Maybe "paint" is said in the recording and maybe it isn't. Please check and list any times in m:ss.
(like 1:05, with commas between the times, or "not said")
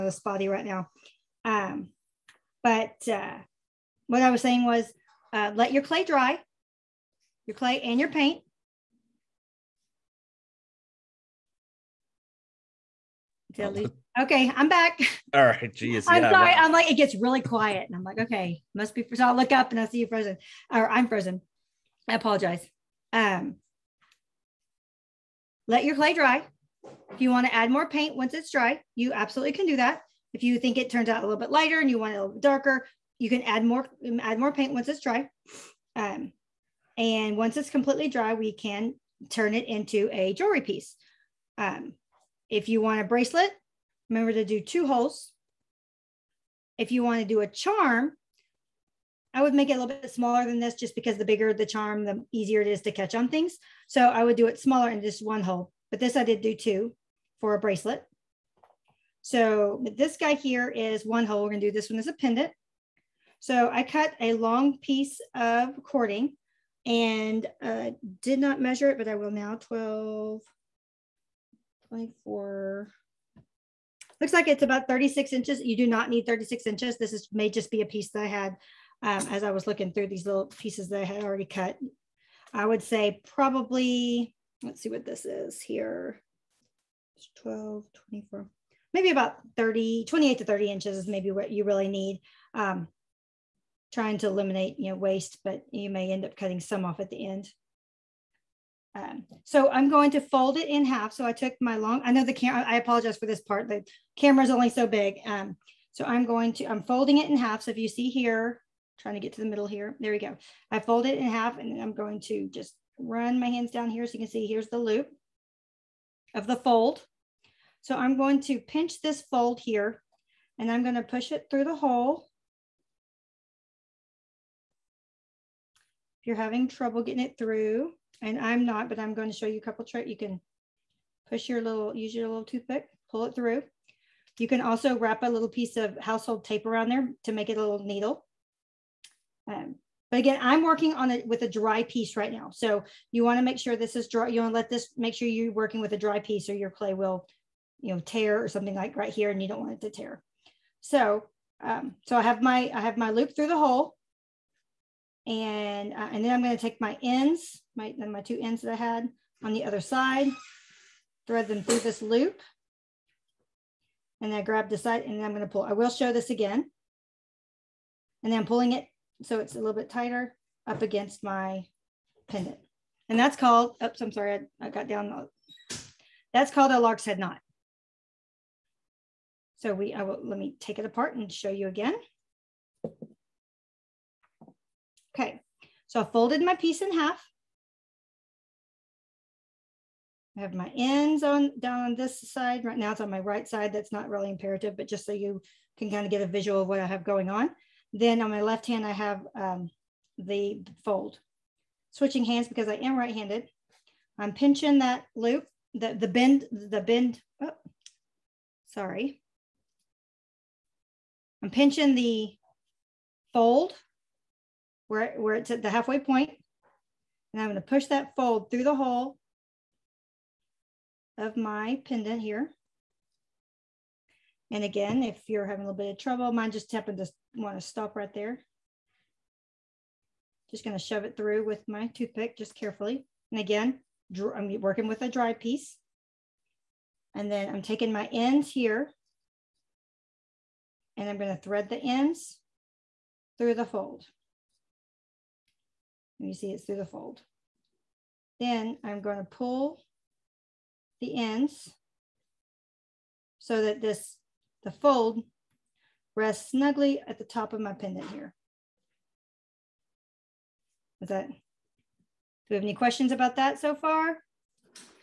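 0:08, 0:27, 0:34.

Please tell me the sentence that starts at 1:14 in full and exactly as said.
Looks like it's about 36 inches.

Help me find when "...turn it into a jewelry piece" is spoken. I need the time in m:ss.
0:39.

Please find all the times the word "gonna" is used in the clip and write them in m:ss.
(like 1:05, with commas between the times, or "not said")
2:00, 2:36, 2:45, 3:37.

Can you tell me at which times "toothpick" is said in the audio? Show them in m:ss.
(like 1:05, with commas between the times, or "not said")
2:12, 3:51.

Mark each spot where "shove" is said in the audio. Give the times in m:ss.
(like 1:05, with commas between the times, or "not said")
3:50.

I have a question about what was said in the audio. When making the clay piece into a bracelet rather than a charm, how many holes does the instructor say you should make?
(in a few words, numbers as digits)
2.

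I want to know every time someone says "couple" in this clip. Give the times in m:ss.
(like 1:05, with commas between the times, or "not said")
2:09.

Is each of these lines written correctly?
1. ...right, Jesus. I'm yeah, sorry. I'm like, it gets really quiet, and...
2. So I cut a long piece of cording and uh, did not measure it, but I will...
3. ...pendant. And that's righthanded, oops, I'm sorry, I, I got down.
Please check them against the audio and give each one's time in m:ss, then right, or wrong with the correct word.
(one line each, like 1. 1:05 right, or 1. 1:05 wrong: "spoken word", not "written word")
1. 0:15 right
2. 1:03 right
3. 2:52 wrong: "called", not "righthanded".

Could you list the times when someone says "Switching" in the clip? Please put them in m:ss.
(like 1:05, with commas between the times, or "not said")
3:21.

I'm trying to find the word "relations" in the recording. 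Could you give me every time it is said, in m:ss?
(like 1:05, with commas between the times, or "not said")
not said.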